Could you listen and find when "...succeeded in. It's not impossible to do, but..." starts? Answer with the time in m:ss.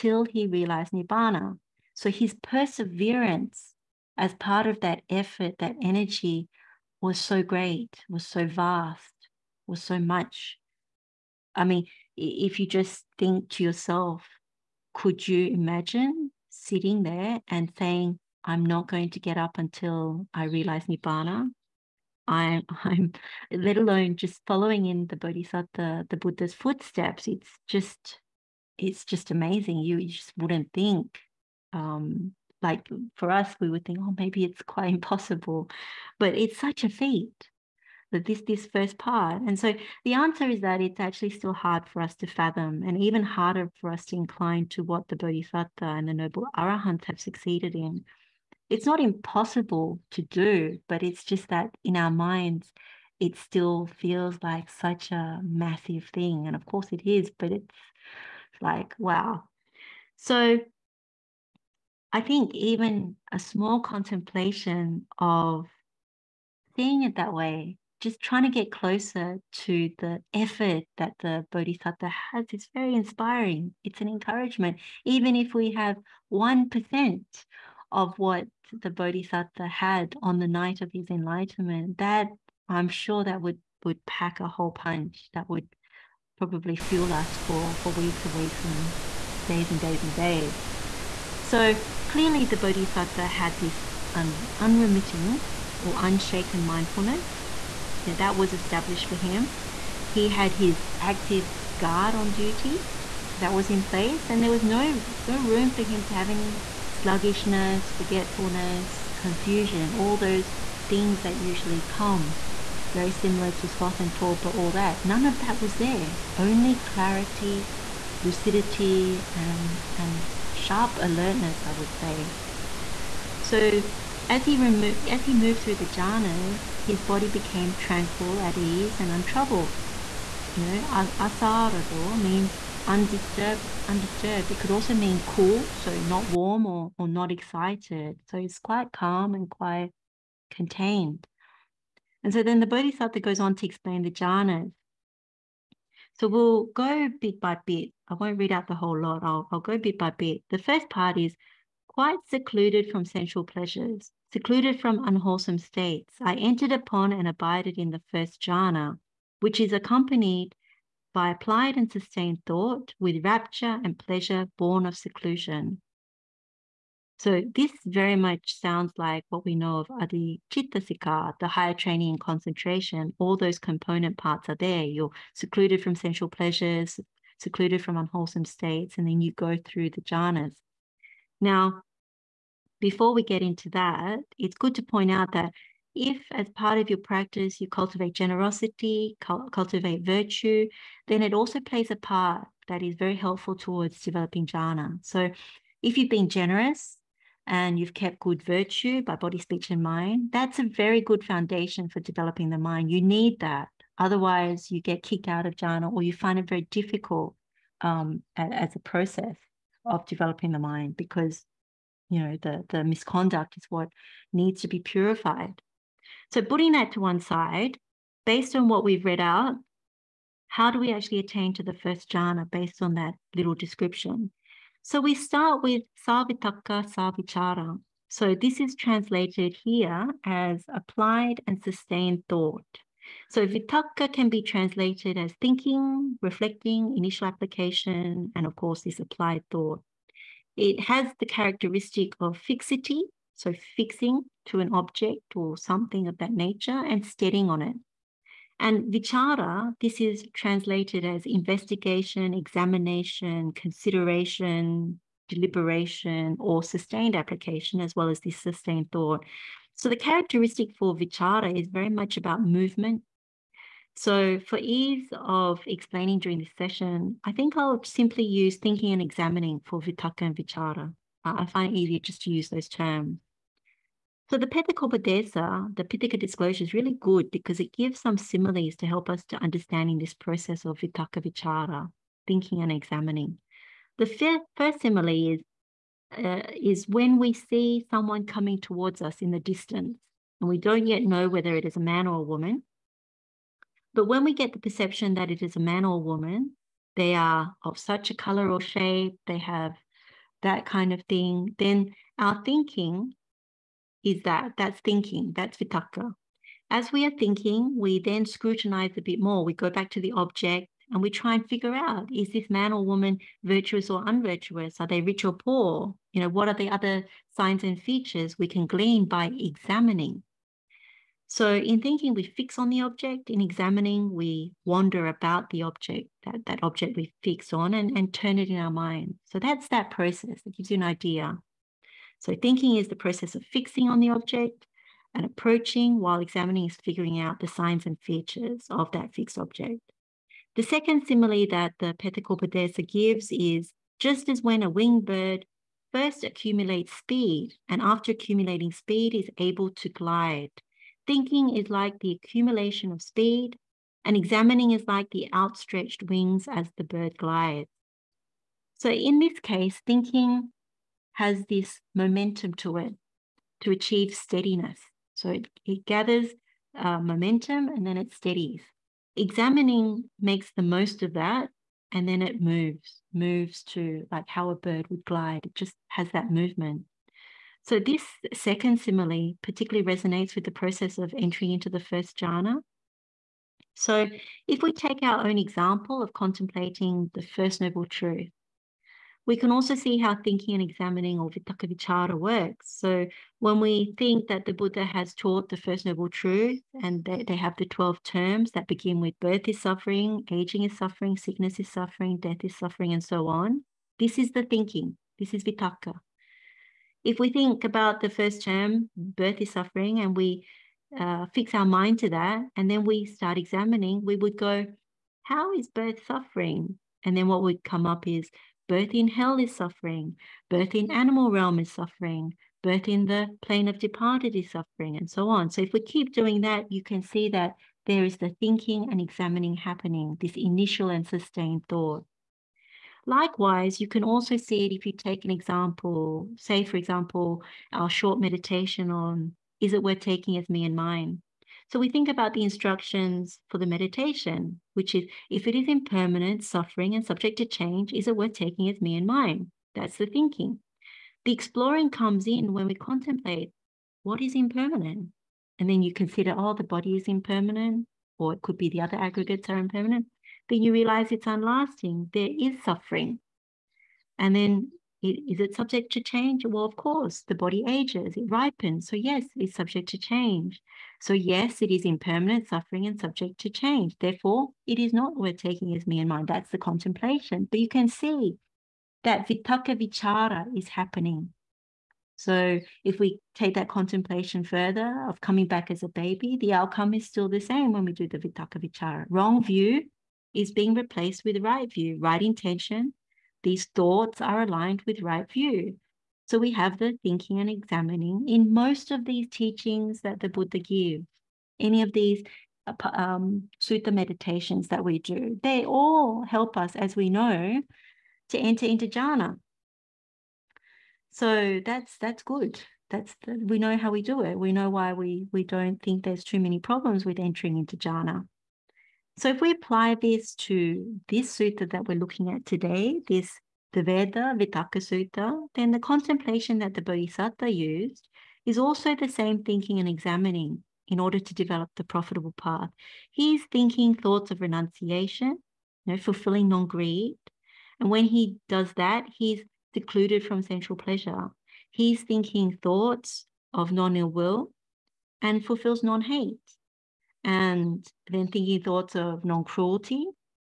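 0:47.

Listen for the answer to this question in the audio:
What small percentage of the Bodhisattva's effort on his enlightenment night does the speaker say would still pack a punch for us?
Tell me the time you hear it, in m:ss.
1:16.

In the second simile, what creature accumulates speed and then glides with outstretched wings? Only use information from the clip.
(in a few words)
a winged bird.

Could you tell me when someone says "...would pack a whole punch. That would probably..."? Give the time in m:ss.
1:23.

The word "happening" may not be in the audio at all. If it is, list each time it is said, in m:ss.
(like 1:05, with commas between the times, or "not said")
7:09, 8:00.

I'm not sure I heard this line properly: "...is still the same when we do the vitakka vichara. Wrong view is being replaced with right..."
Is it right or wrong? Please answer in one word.
right.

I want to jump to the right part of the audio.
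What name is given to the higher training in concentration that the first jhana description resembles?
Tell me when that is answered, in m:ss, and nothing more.
2:49.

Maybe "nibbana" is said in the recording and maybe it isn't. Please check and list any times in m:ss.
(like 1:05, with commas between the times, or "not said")
0:00, 0:20.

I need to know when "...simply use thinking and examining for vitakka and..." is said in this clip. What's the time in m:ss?
4:27.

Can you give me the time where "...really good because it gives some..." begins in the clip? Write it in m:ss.
4:36.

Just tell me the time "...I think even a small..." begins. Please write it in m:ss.
1:02.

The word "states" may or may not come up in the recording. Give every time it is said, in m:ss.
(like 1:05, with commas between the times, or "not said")
2:35, 2:58.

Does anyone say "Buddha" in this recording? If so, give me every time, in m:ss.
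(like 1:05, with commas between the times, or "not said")
0:26, 6:34, 8:20.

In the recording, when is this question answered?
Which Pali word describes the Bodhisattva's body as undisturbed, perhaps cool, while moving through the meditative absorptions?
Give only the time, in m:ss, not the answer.
2:11.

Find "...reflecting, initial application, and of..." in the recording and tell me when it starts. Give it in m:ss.
3:56.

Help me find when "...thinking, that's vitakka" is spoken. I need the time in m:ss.
5:04.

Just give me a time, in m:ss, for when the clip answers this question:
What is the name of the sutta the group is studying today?
8:43.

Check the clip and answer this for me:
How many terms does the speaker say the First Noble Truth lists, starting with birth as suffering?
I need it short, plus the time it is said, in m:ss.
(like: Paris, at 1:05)
12, at 6:37.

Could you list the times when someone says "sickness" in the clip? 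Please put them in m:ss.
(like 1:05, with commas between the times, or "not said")
6:41.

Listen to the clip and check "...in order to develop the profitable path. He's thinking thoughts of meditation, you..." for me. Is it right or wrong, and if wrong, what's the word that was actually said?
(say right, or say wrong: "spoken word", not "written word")
wrong: "renunciation", not "meditation".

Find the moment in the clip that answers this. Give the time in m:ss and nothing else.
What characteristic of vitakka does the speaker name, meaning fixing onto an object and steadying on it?
4:02.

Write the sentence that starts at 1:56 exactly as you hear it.
Only clarity, lucidity, and, and sharp alertness, I would say.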